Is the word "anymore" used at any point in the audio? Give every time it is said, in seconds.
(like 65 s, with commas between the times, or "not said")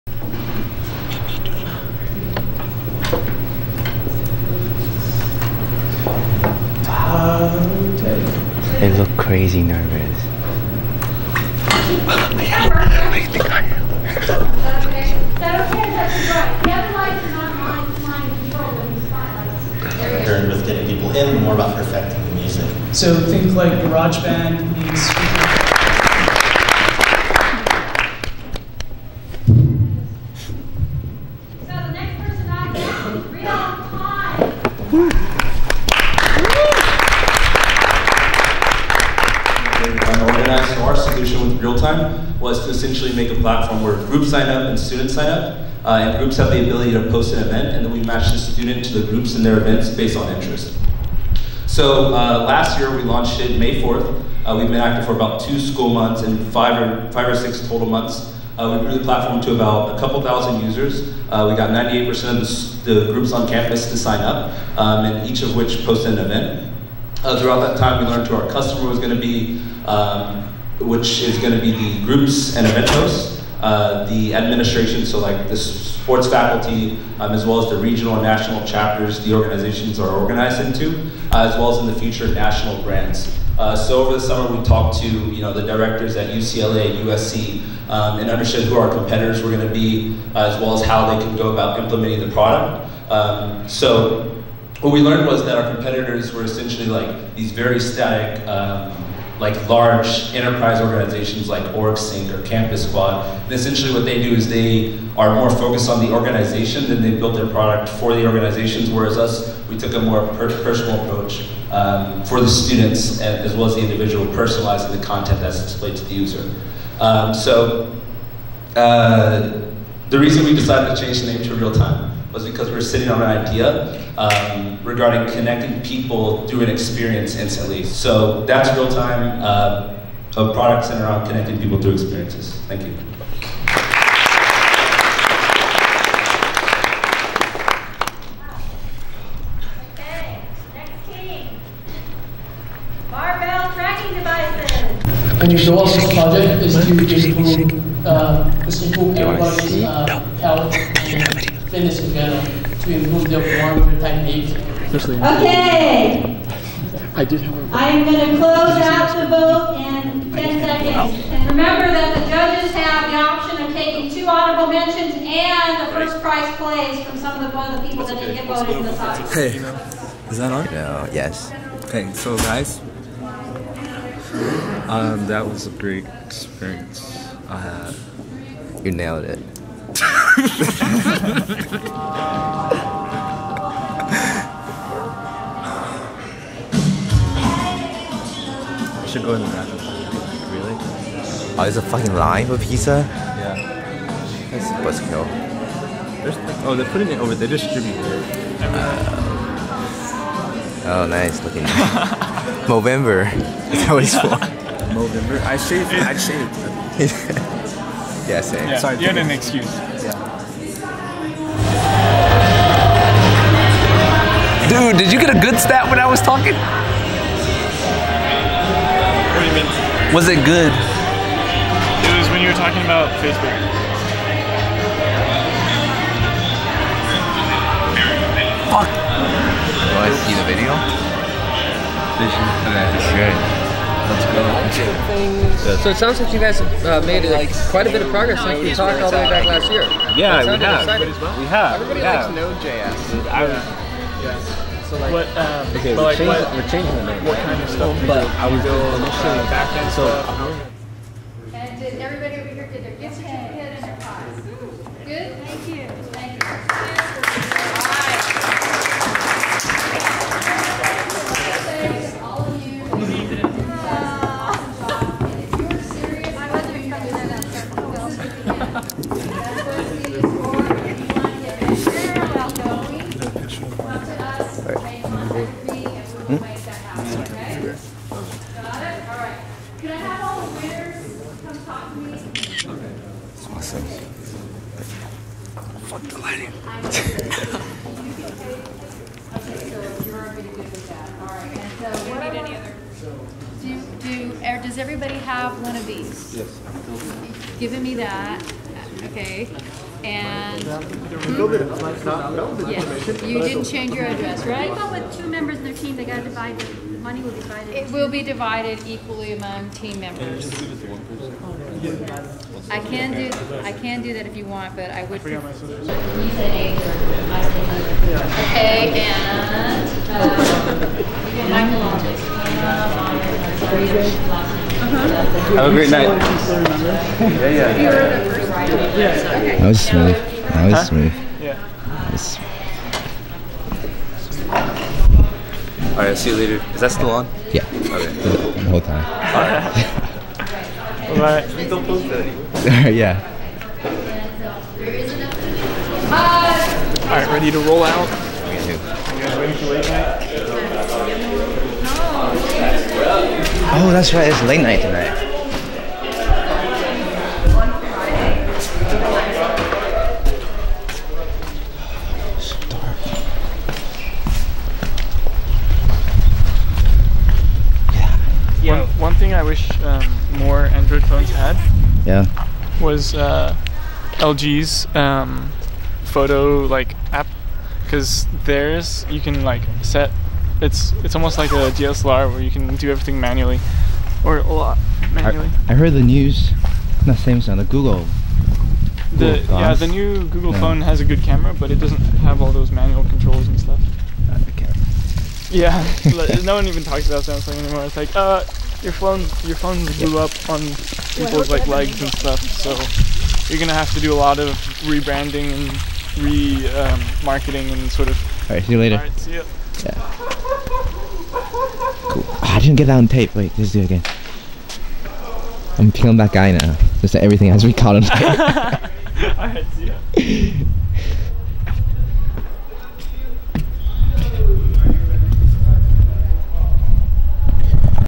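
342 s, 397 s.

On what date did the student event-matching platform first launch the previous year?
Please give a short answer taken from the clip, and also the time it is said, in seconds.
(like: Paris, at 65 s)
May 4th, at 53 s.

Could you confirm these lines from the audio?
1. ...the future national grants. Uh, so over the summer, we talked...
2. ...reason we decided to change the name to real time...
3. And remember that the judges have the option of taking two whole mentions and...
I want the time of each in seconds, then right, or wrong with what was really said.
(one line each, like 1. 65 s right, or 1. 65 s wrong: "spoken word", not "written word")
1. 81 s right
2. 120 s right
3. 161 s wrong: "honorable", not "whole".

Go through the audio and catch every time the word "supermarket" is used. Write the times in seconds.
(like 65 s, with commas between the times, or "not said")
not said.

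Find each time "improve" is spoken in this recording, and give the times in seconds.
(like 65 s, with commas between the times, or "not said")
152 s.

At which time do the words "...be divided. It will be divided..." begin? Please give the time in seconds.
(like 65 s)
307 s.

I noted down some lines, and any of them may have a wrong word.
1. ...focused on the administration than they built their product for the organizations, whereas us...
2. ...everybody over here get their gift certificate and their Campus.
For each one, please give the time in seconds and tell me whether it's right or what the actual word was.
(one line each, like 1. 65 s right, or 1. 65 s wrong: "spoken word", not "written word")
1. 105 s wrong: "organization", not "administration"
2. 252 s wrong: "Good", not "Campus".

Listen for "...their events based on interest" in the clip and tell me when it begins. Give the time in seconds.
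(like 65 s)
49 s.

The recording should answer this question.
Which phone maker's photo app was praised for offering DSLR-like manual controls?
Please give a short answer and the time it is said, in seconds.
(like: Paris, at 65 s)
LG, at 374 s.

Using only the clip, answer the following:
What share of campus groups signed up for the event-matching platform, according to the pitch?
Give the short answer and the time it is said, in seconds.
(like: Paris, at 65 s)
98%, at 61 s.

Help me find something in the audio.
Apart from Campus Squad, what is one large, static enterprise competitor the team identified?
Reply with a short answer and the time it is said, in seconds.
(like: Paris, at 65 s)
OrgSync, at 101 s.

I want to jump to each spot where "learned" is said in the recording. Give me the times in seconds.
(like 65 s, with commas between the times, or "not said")
68 s, 94 s.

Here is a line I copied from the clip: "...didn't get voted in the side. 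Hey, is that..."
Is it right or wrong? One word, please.
right.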